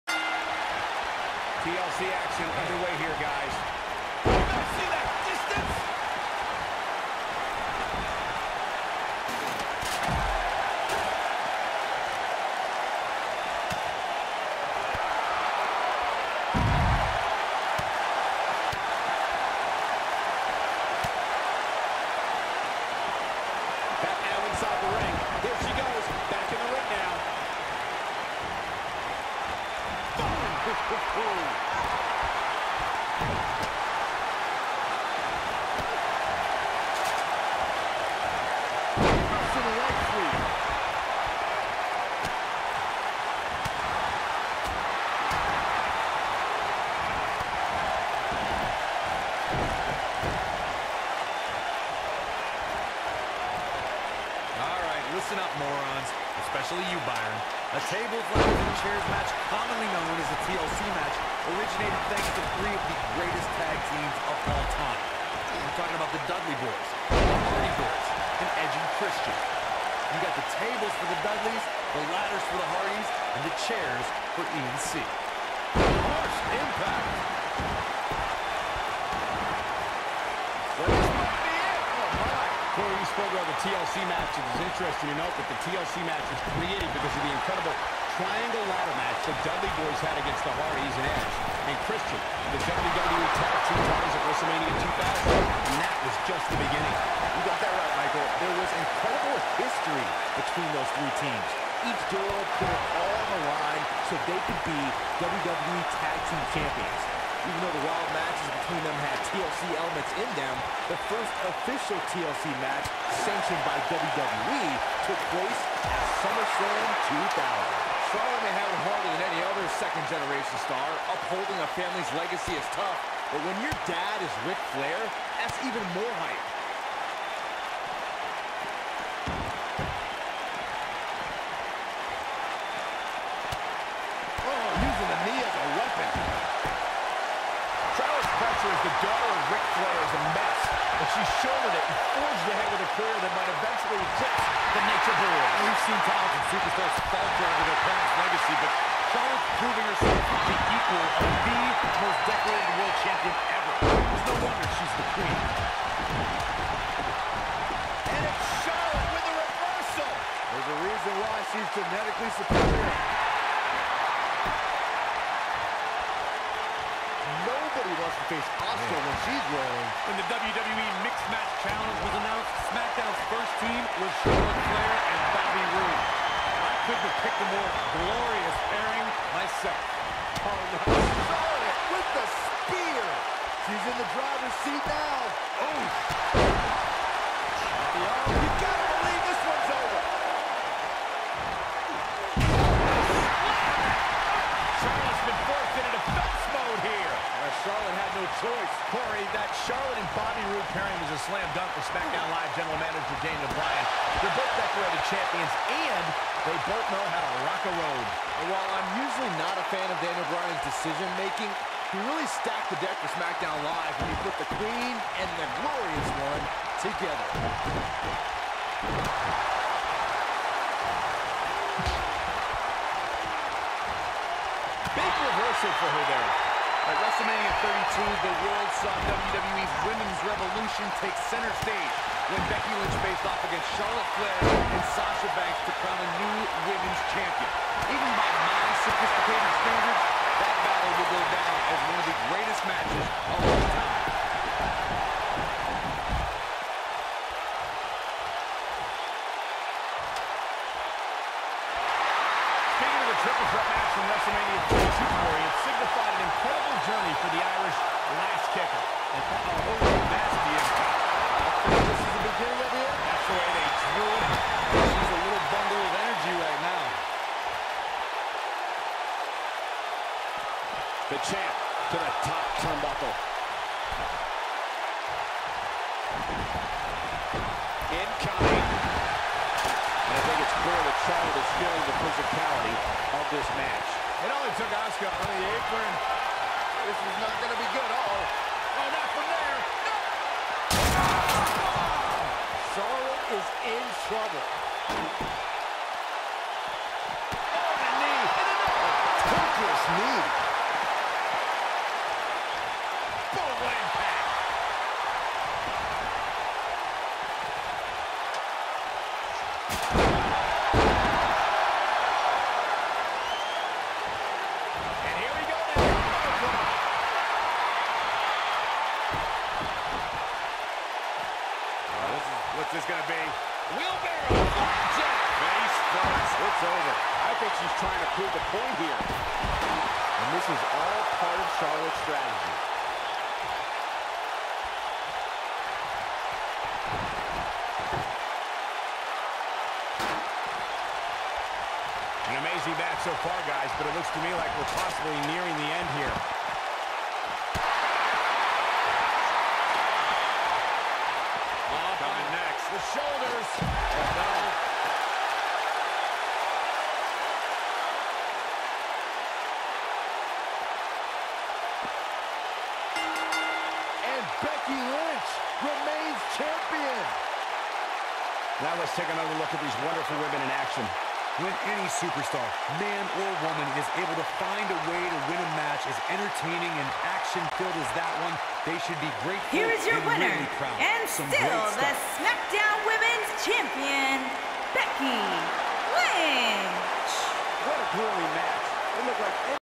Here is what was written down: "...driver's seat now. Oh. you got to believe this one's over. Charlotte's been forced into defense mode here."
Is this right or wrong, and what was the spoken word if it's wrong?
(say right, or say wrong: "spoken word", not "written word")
right.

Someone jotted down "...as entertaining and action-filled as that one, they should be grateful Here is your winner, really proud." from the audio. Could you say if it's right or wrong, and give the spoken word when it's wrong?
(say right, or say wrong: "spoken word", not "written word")
right.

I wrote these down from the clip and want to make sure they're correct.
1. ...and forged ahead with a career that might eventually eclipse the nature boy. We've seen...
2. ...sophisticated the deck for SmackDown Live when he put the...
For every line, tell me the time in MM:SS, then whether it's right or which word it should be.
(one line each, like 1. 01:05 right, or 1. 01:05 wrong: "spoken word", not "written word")
1. 02:21 right
2. 03:32 wrong: "stacked", not "sophisticated".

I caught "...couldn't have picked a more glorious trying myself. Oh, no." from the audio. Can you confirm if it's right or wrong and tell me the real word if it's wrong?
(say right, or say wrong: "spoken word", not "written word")
wrong: "pairing", not "trying".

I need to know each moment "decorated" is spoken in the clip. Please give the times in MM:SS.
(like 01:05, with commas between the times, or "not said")
02:32, 03:24.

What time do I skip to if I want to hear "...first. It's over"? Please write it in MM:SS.
05:25.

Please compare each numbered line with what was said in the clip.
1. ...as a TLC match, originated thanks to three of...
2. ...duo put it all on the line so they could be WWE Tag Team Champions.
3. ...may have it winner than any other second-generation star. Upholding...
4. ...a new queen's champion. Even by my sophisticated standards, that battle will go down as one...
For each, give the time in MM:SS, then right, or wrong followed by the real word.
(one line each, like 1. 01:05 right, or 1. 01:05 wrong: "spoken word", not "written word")
1. 01:00 right
2. 01:42 right
3. 01:58 wrong: "harder", not "winner"
4. 03:56 wrong: "women", not "queen".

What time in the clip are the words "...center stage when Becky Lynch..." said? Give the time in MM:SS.
03:51.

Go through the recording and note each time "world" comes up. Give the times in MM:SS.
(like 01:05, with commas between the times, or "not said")
02:32, 03:48.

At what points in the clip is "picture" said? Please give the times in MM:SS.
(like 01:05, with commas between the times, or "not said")
02:18.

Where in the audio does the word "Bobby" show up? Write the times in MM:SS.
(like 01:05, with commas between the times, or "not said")
02:55, 03:20.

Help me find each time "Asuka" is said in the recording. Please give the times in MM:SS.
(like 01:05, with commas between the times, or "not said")
02:48, 04:44.